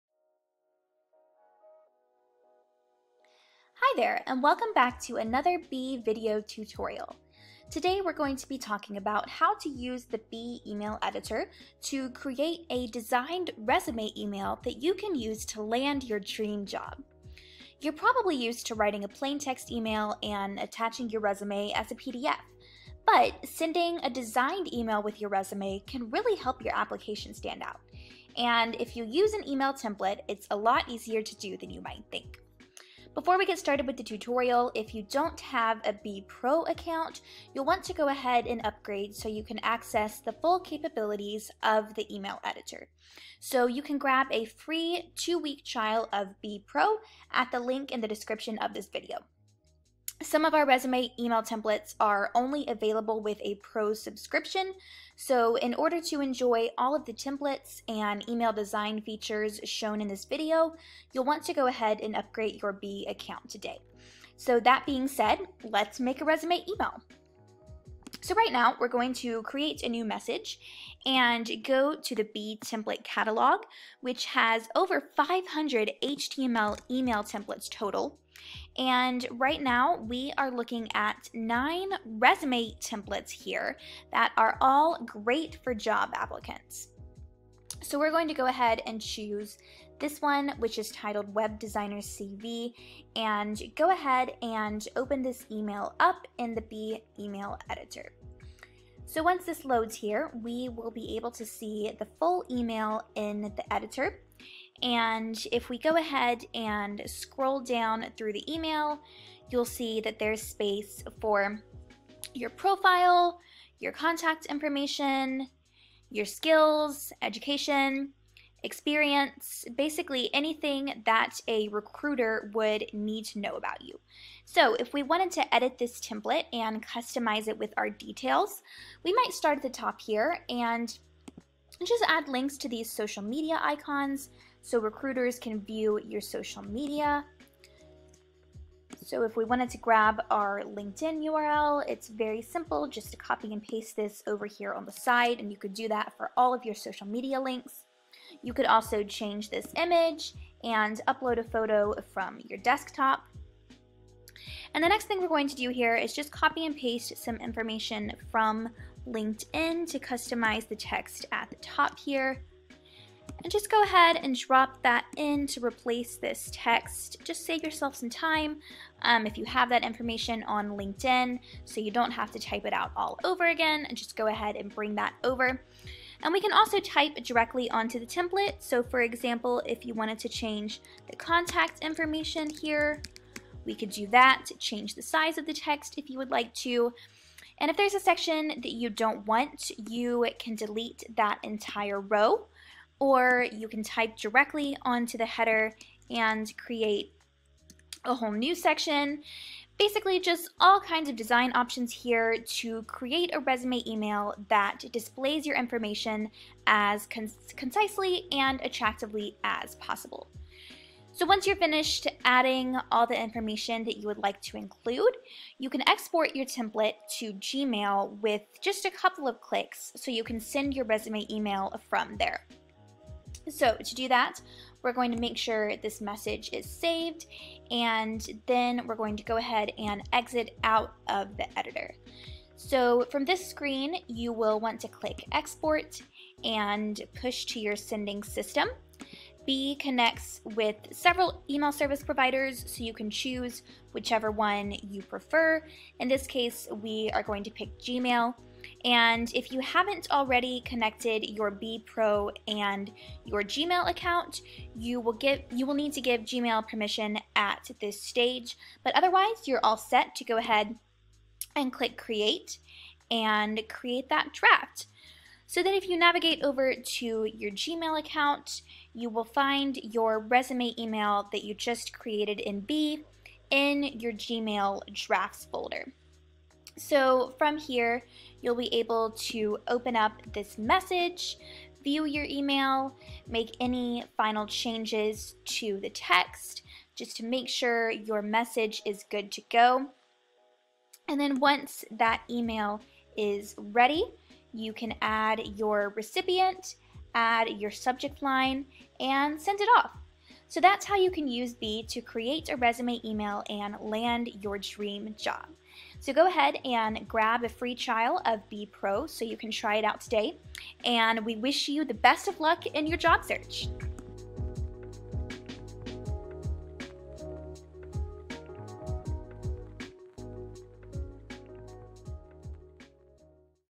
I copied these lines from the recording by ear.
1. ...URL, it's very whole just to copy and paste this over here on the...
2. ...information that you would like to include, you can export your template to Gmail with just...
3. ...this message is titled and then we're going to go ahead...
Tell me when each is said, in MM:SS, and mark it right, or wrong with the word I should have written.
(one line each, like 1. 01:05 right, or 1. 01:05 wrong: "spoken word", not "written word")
1. 02:21 wrong: "simple", not "whole"
2. 03:33 right
3. 03:45 wrong: "saved", not "titled".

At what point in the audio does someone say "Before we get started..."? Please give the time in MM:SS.
00:33.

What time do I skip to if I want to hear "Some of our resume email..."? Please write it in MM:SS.
00:50.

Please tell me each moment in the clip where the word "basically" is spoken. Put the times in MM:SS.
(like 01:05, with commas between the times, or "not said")
01:59, 03:19.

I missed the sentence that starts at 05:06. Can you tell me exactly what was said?
So go ahead and grab a free trial of Bee Pro so you can try it out today.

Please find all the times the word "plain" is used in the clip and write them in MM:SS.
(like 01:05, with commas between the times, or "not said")
00:19.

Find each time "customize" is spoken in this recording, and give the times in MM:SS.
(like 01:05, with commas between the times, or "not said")
02:06, 02:39.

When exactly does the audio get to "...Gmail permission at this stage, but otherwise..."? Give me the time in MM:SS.
04:16.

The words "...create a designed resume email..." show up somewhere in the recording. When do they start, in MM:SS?
00:12.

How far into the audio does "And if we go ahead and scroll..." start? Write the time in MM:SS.
01:44.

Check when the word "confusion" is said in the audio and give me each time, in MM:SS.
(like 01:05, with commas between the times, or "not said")
not said.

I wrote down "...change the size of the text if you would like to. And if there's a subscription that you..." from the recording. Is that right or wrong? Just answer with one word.
wrong.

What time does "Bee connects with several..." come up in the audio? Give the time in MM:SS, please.
03:59.